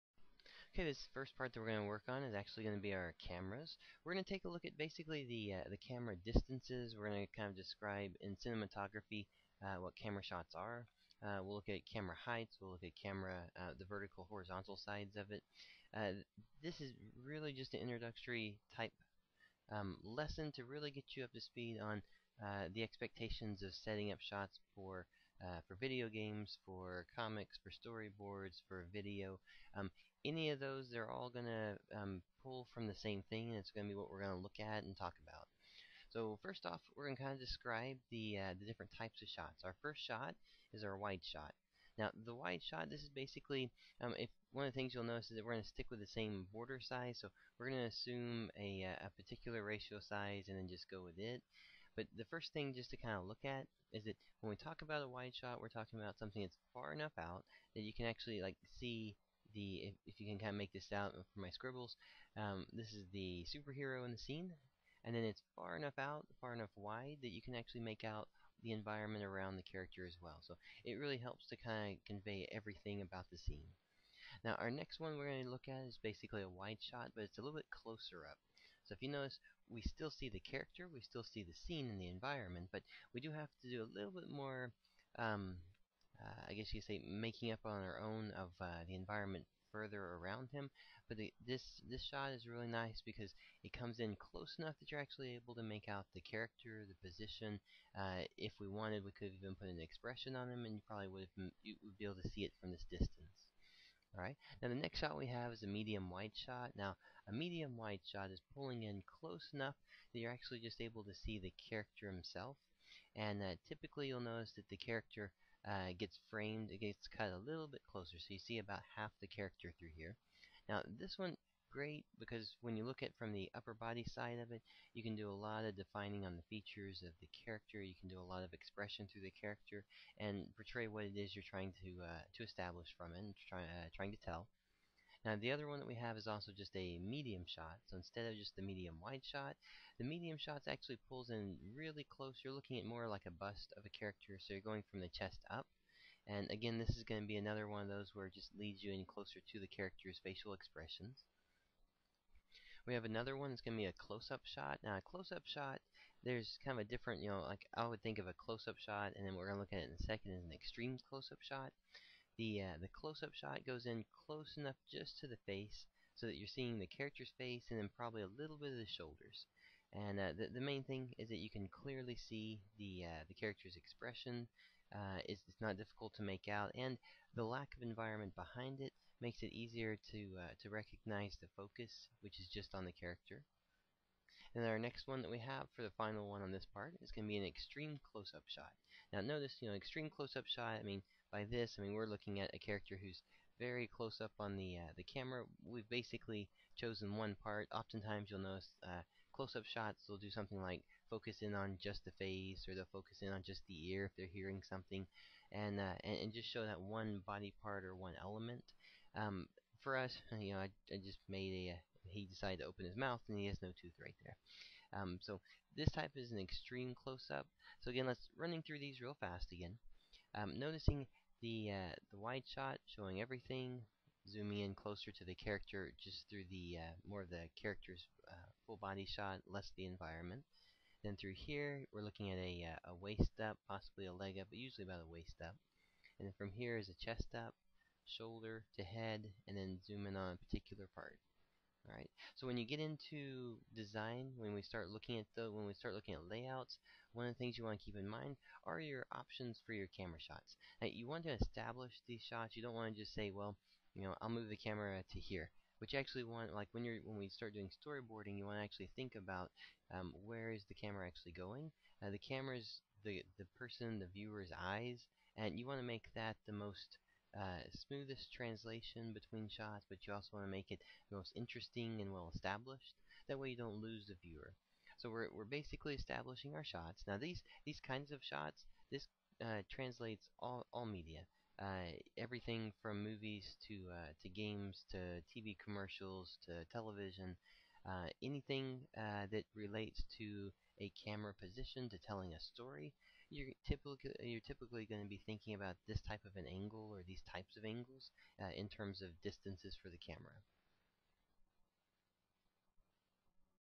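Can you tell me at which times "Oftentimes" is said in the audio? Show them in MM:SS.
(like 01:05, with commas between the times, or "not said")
03:17.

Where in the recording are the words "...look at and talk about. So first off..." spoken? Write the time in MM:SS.
00:34.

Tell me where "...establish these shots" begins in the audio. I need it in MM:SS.
04:11.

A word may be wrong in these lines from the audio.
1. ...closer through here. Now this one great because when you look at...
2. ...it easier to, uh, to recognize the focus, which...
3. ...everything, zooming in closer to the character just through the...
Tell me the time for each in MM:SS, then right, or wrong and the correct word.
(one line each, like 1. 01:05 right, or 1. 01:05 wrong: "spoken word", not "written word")
1. 01:59 wrong: "character", not "closer"
2. 02:59 right
3. 03:43 right.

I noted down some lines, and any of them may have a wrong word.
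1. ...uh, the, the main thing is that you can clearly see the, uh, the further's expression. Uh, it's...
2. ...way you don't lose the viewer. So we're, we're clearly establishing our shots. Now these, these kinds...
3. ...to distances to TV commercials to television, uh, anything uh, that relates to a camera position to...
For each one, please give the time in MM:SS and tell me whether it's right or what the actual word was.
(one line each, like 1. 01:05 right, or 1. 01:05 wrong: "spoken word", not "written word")
1. 02:50 wrong: "character", not "further"
2. 04:33 wrong: "basically", not "clearly"
3. 04:44 wrong: "games", not "distances".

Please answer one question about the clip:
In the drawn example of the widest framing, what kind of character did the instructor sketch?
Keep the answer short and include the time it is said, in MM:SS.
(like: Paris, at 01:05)
superhero, at 01:03.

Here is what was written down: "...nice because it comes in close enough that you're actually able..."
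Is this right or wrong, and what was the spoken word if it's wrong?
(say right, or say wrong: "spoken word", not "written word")
right.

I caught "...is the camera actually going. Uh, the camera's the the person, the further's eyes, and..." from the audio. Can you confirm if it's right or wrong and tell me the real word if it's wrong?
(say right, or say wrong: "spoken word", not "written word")
wrong: "viewer", not "further".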